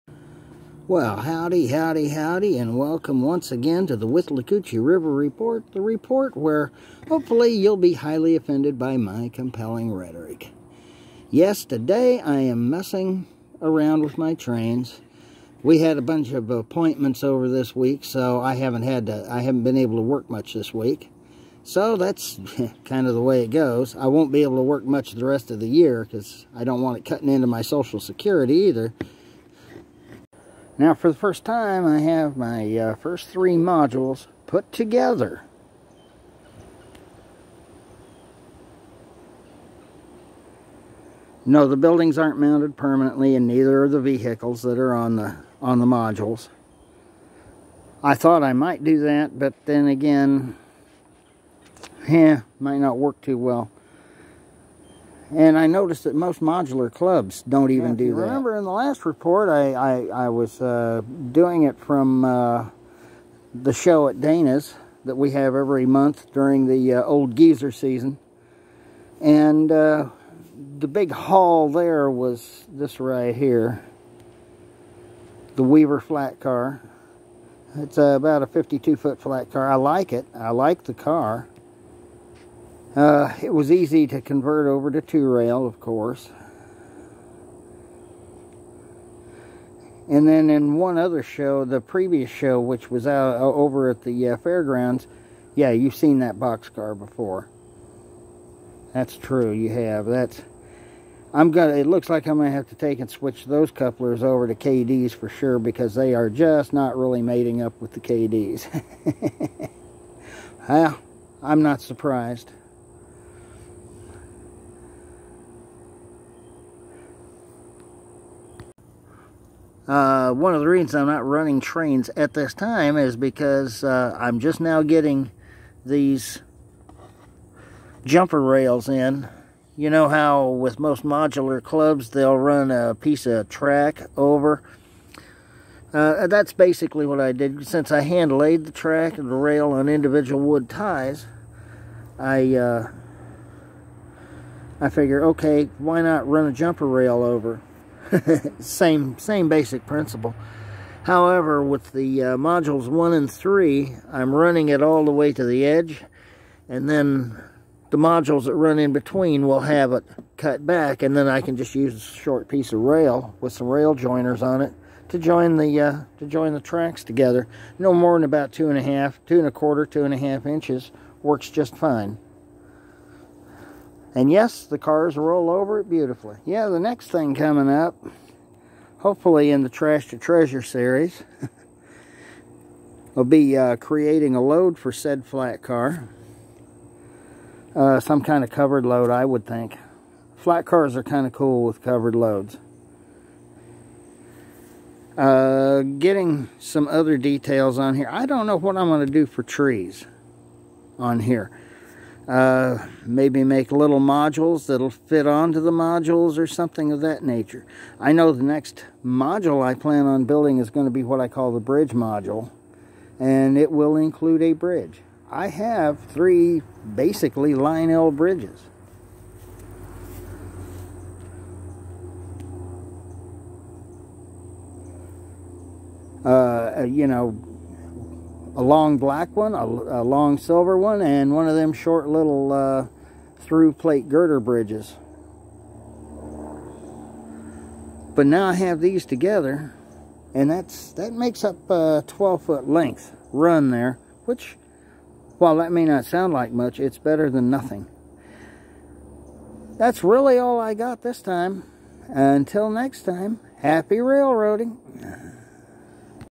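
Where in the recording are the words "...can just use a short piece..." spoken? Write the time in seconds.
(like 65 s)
161 s.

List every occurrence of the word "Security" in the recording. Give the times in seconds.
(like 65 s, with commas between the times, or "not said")
28 s.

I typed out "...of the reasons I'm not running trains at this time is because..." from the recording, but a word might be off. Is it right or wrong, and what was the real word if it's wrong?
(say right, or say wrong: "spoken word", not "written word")
right.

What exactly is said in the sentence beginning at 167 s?
No more than about two and a half, two and a quarter, two and a half inches works just fine.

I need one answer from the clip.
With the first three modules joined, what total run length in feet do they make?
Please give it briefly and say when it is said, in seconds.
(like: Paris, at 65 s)
12 foot, at 242 s.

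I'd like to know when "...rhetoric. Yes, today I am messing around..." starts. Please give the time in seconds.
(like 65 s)
9 s.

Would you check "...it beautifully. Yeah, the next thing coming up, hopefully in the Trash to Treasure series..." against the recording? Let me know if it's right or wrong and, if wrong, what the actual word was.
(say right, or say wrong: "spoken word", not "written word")
right.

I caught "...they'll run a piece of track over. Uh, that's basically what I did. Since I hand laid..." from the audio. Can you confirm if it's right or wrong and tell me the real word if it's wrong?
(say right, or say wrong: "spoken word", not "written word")
right.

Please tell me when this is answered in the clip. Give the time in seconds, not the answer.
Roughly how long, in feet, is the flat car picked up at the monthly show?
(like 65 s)
78 s.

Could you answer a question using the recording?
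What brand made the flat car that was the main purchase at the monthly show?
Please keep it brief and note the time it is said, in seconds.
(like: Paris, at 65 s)
Weaver, at 75 s.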